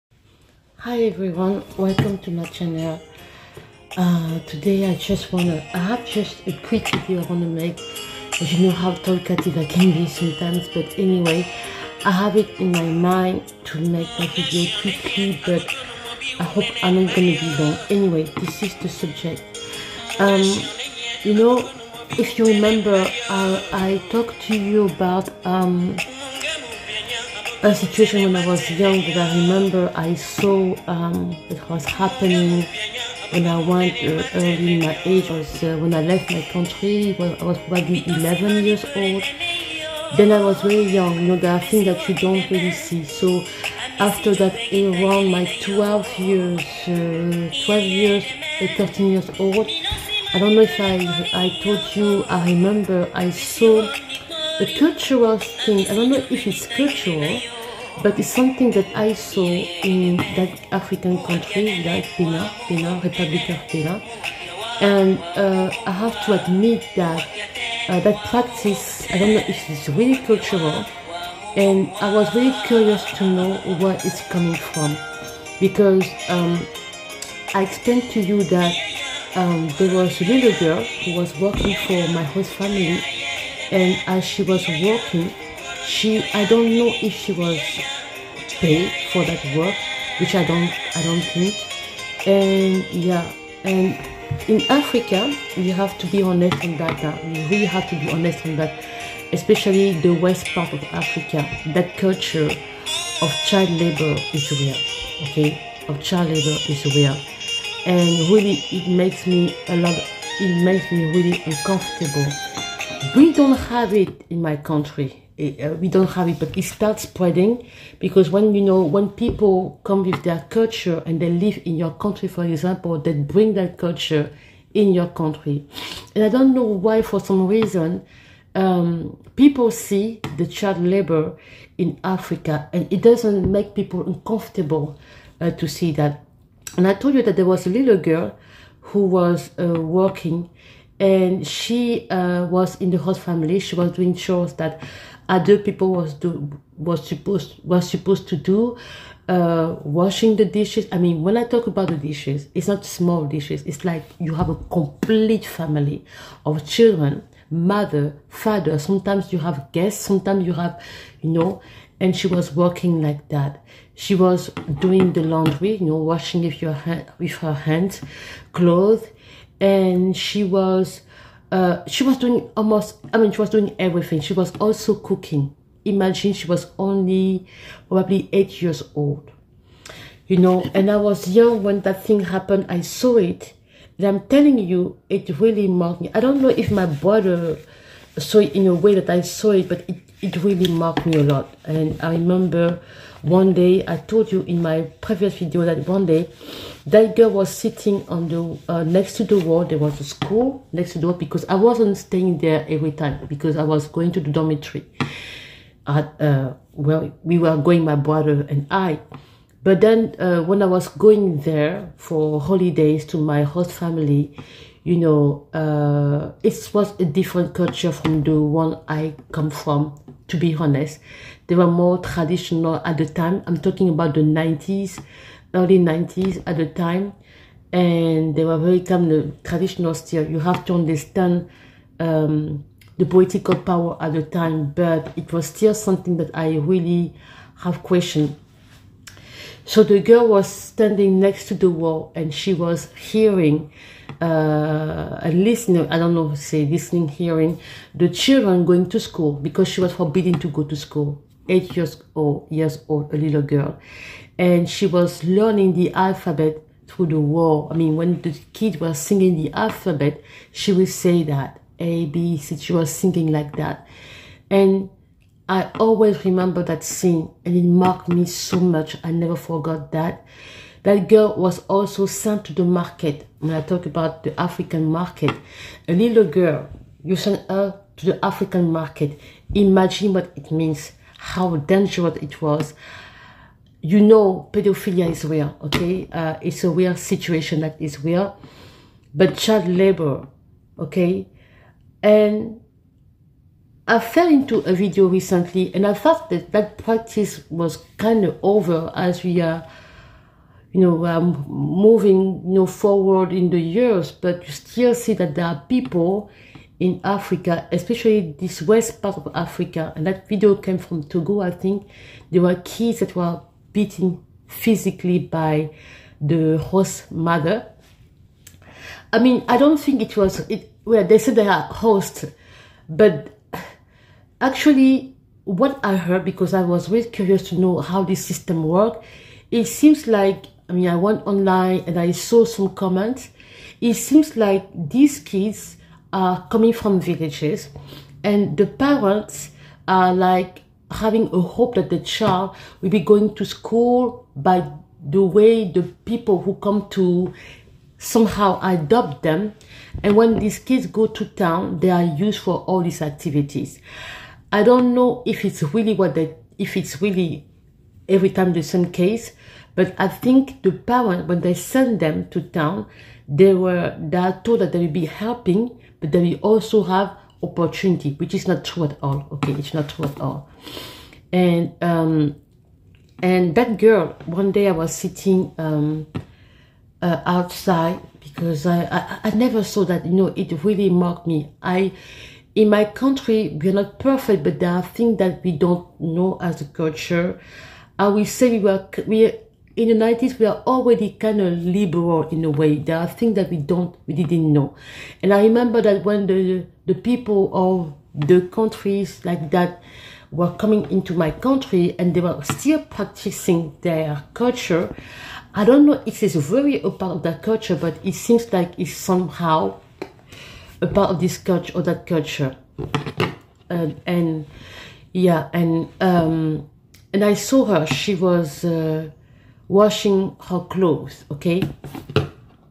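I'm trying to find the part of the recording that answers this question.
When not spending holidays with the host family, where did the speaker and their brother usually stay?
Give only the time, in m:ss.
3:24.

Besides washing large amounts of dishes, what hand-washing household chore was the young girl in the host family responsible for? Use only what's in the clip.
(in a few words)
Laundry.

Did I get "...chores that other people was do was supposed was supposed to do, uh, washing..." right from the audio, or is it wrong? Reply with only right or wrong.
right.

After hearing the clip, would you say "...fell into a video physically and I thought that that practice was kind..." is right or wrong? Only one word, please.
wrong.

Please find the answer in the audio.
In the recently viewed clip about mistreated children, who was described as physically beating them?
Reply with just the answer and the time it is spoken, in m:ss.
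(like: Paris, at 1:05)
The host mother, at 5:16.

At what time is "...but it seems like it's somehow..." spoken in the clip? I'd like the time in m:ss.
6:47.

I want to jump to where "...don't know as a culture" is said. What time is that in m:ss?
6:25.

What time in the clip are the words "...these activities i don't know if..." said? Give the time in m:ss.
5:52.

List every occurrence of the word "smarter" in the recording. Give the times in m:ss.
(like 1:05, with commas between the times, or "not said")
not said.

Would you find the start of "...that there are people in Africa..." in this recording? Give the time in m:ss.
5:05.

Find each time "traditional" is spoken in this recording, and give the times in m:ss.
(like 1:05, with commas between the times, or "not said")
3:41, 3:49.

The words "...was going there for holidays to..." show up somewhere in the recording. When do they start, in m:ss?
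3:30.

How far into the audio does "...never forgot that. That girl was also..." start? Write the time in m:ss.
4:29.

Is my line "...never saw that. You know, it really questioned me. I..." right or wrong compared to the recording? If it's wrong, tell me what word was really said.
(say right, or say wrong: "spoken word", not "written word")
wrong: "marked", not "questioned".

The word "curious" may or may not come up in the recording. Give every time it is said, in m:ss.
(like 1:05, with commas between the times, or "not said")
1:12, 5:27.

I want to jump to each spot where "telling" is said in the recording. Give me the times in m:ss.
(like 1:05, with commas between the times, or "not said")
3:04.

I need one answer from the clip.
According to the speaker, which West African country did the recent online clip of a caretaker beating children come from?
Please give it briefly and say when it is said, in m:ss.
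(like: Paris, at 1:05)
Togo, at 5:11.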